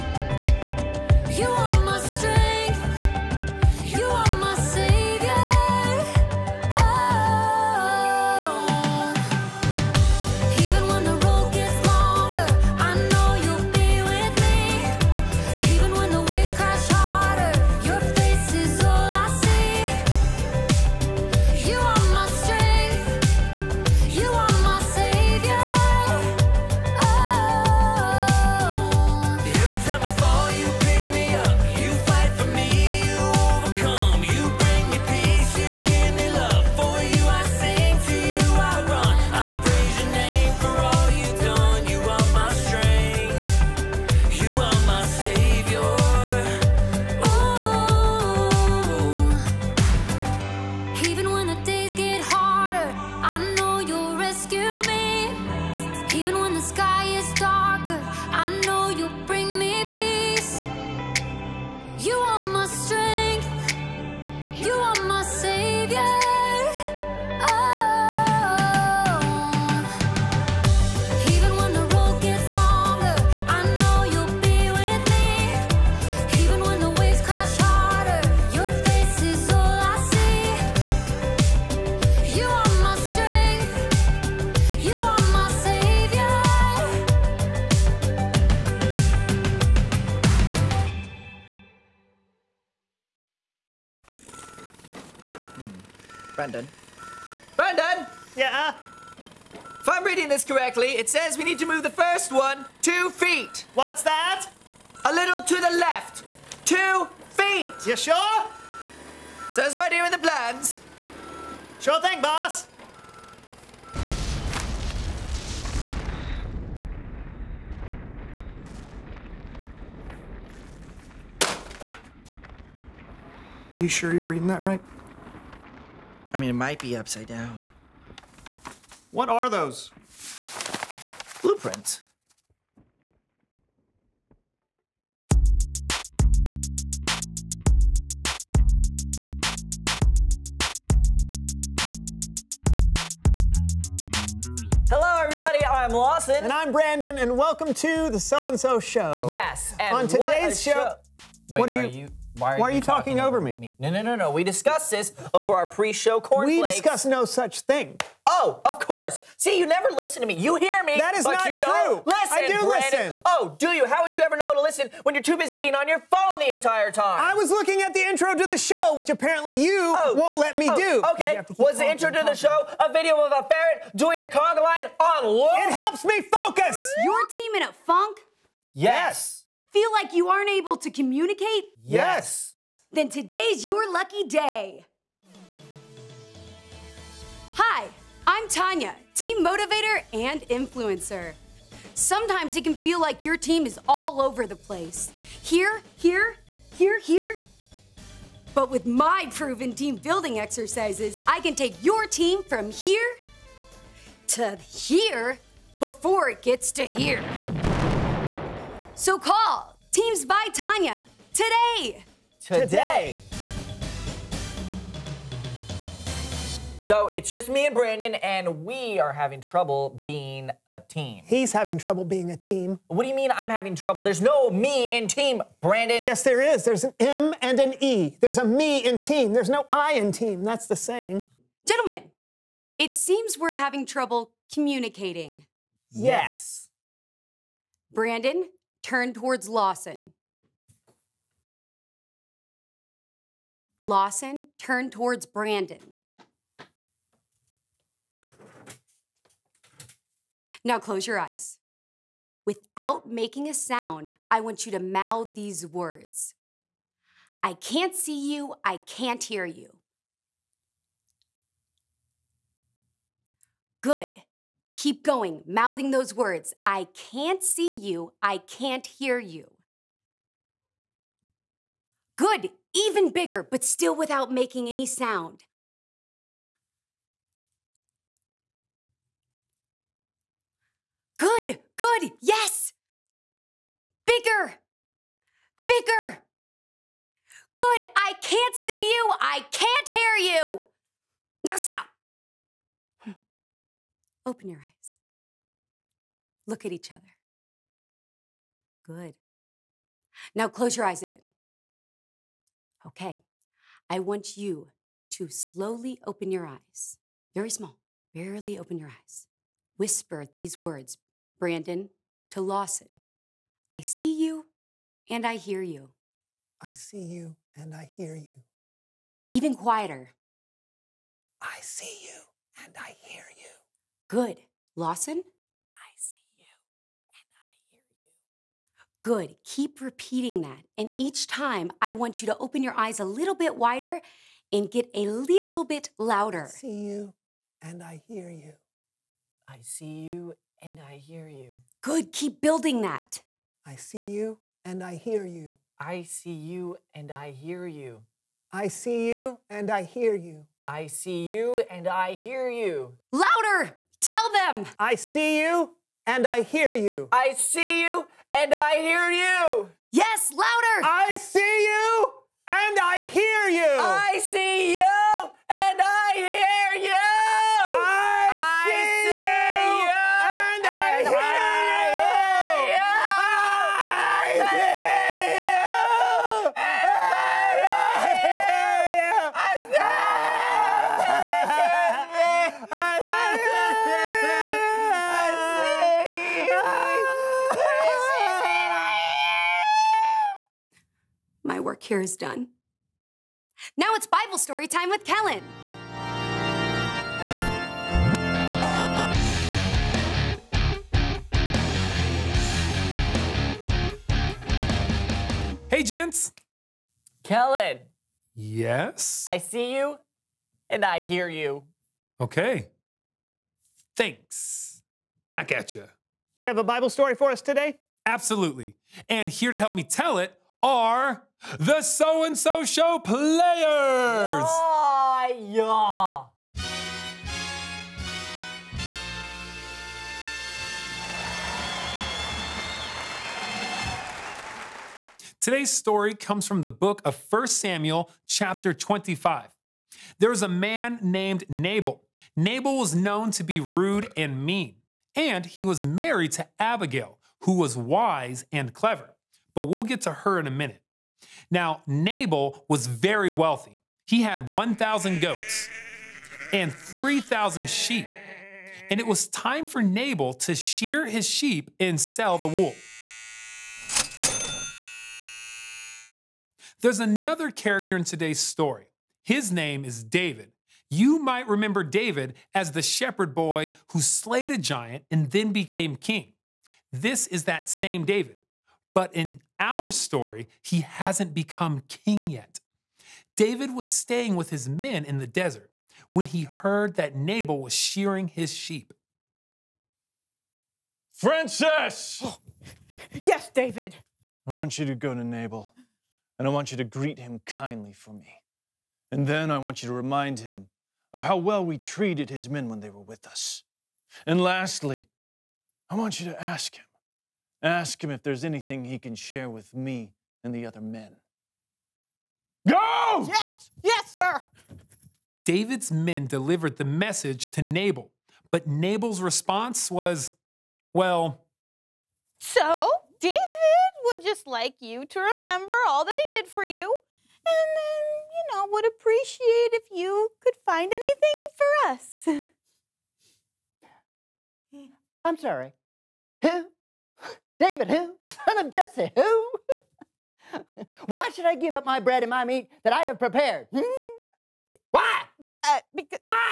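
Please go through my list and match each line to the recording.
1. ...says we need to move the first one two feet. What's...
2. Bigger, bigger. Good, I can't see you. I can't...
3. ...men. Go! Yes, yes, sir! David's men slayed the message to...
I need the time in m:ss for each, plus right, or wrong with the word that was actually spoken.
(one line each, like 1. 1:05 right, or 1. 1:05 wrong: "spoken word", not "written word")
1. 1:41 right
2. 4:44 right
3. 8:30 wrong: "delivered", not "slayed".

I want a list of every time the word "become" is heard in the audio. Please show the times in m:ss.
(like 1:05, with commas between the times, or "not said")
8:01.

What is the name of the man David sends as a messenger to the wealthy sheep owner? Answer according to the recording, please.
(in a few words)
Francis.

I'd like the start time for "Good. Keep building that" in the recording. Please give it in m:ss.
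5:41.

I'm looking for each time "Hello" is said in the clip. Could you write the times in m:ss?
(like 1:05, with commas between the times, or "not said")
2:24.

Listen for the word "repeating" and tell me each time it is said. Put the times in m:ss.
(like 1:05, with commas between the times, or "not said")
5:29.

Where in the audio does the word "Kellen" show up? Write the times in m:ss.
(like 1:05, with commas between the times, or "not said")
6:35, 6:47.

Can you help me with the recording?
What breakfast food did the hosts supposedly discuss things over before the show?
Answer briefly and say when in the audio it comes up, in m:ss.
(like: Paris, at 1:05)
Cornflakes, at 2:36.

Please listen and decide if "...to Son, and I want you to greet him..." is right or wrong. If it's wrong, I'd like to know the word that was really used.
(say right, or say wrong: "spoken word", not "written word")
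wrong: "Nabal", not "Son".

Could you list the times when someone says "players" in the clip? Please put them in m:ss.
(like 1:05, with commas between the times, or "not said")
7:02.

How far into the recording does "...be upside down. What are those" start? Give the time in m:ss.
2:06.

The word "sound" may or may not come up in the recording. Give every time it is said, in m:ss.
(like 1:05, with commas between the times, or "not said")
4:13, 4:34.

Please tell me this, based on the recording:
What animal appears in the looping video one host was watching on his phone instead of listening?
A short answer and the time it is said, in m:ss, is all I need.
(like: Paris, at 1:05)
A ferret, at 2:53.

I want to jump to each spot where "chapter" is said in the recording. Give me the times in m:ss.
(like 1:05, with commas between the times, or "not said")
7:18.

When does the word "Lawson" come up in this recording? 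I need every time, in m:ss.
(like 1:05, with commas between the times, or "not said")
2:25, 3:59, 4:03, 5:12, 5:24.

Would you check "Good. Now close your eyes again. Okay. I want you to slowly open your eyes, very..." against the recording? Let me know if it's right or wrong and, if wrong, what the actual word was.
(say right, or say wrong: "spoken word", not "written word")
right.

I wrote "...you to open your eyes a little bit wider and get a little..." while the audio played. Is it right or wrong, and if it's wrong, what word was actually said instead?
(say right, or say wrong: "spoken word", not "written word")
right.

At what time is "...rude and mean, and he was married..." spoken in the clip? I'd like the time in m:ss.
7:23.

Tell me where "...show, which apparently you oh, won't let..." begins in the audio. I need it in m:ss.
2:48.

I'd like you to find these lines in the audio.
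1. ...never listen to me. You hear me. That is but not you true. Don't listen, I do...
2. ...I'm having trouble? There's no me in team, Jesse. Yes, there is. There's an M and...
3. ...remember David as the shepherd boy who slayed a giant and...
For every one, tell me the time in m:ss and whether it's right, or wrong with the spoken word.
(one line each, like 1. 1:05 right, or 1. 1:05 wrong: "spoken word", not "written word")
1. 2:39 right
2. 3:43 wrong: "Brandon", not "Jesse"
3. 7:51 right.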